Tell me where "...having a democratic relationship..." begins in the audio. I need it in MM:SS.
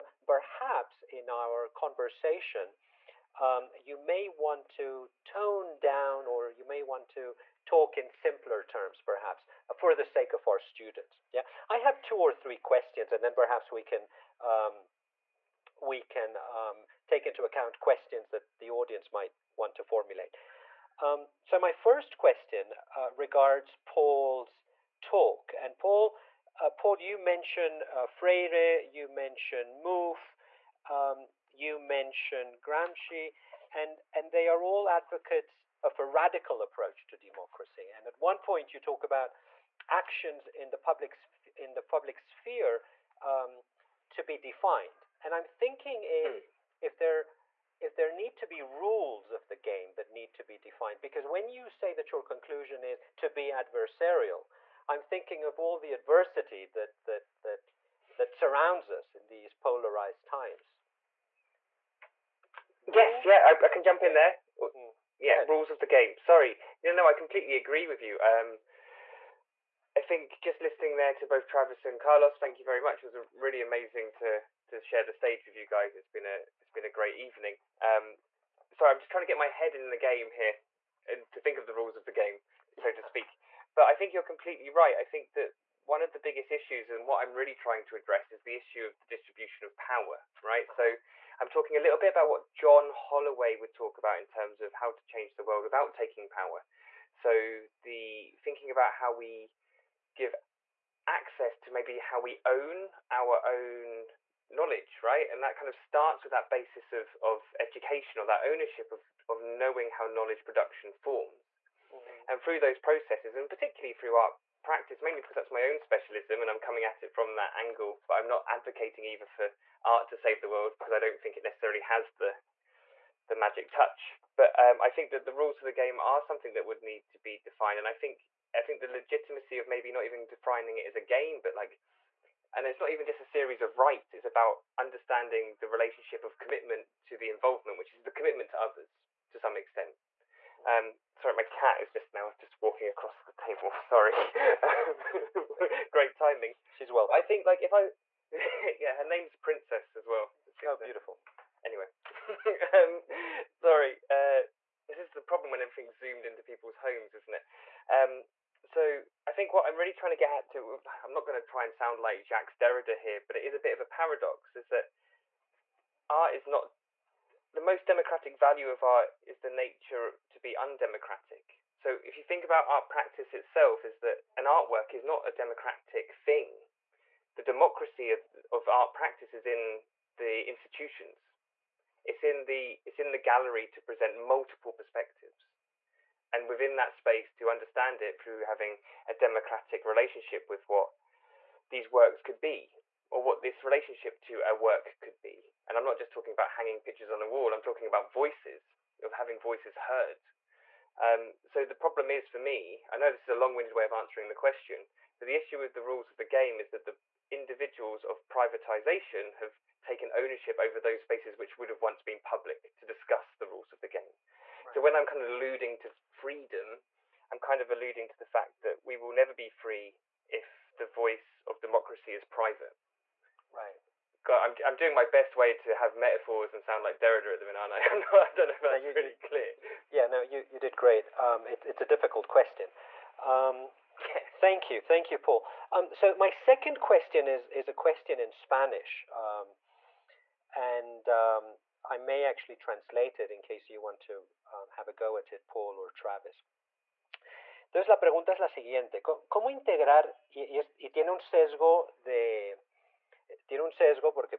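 03:08.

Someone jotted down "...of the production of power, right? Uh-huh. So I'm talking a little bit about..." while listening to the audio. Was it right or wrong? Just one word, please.
wrong.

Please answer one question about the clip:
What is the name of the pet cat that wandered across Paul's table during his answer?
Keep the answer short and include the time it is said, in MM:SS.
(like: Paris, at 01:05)
Princess, at 02:29.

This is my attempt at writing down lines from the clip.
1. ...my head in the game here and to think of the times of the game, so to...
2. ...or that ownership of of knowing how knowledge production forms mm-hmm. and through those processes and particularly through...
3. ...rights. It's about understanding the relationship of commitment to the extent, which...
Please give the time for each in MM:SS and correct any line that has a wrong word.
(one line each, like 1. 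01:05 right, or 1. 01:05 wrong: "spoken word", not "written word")
1. 01:19 wrong: "rules", not "times"
2. 01:48 right
3. 02:13 wrong: "involvement", not "extent".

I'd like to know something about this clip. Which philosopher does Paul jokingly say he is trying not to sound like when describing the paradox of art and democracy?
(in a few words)
Jacques Derrida.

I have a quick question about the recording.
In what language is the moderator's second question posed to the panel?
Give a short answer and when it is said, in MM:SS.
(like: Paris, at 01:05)
Spanish, at 03:58.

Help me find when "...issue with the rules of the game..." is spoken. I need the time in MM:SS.
03:25.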